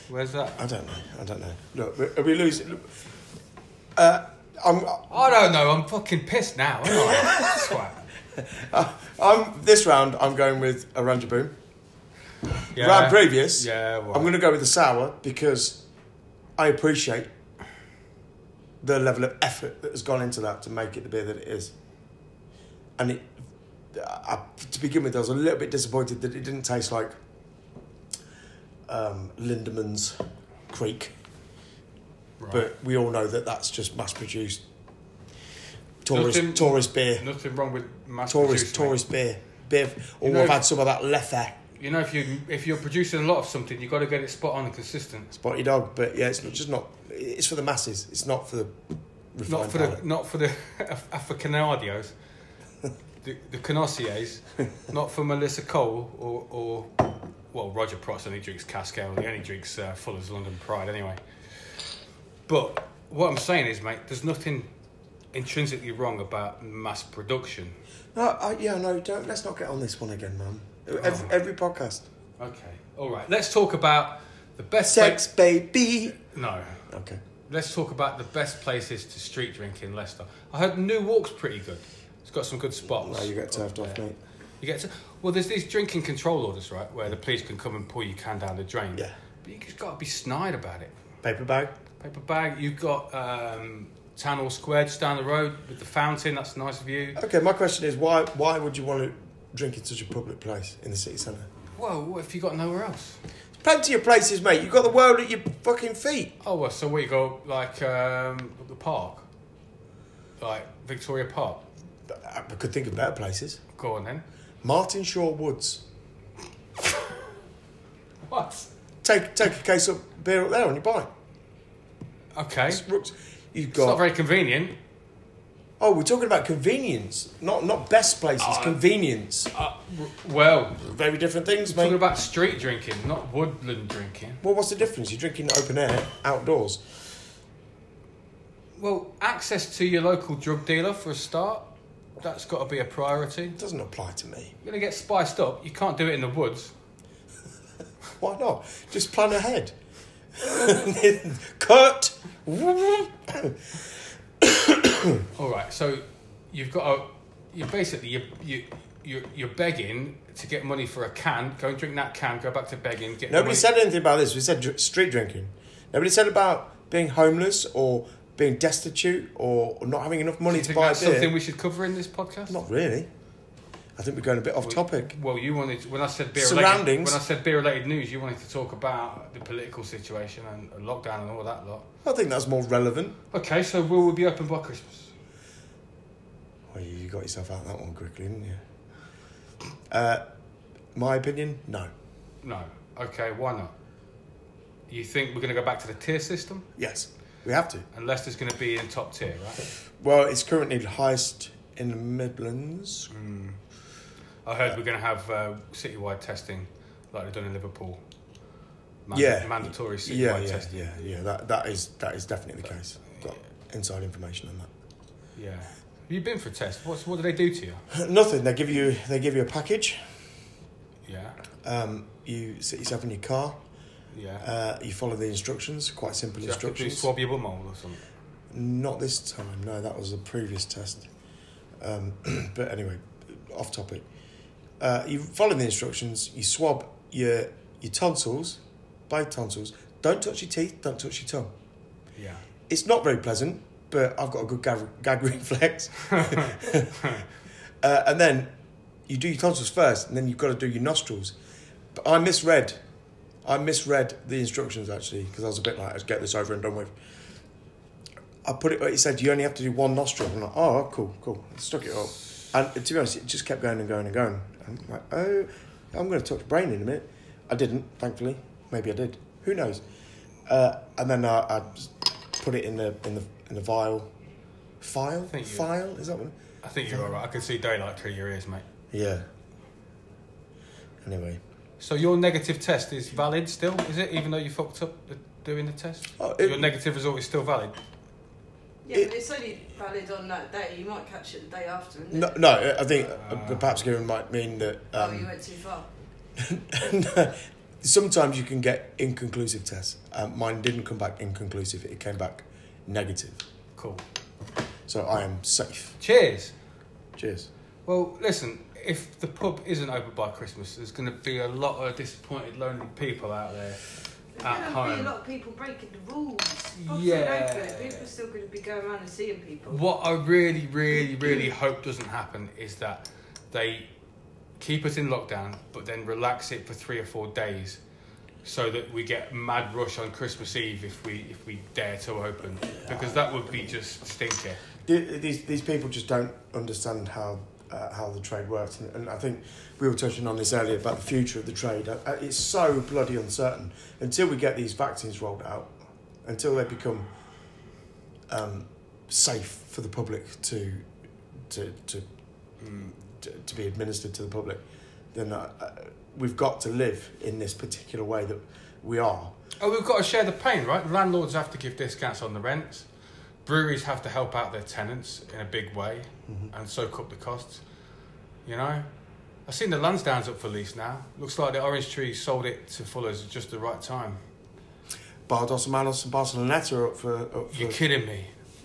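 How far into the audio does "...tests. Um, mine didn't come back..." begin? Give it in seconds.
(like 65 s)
299 s.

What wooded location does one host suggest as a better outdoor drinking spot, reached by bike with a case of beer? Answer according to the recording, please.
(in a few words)
Martinshaw Woods.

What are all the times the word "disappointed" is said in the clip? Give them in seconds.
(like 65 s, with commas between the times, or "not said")
25 s, 311 s.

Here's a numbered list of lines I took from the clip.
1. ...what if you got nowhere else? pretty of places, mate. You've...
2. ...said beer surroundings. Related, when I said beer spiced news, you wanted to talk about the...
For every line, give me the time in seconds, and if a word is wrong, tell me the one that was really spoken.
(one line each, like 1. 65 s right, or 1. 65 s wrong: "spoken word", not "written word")
1. 102 s wrong: "plenty", not "pretty"
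2. 176 s wrong: "related", not "spiced".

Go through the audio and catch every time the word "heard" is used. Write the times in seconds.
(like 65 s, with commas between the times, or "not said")
80 s, 204 s.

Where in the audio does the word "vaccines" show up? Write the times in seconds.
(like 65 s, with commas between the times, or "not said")
344 s.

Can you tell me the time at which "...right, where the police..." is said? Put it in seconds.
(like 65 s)
86 s.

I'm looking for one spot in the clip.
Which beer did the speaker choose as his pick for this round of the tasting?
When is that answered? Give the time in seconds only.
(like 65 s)
10 s.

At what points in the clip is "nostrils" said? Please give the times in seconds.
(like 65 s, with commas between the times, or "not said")
250 s, 259 s.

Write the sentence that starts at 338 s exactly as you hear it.
And, and, I think we were touching on this earlier about the future of the trade.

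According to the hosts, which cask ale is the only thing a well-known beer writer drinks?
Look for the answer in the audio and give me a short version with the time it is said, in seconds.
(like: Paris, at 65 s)
Fuller's London Pride, at 59 s.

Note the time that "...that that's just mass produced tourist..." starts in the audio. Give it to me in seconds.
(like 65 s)
33 s.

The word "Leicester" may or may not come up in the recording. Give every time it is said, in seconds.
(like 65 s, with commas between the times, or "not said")
79 s, 198 s.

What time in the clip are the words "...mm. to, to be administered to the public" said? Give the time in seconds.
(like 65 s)
352 s.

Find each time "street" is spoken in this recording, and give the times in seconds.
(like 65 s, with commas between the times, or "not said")
79 s, 132 s, 164 s.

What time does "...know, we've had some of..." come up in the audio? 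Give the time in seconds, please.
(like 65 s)
40 s.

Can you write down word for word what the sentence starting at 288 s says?
Yeah, it, but it's only valid on that day.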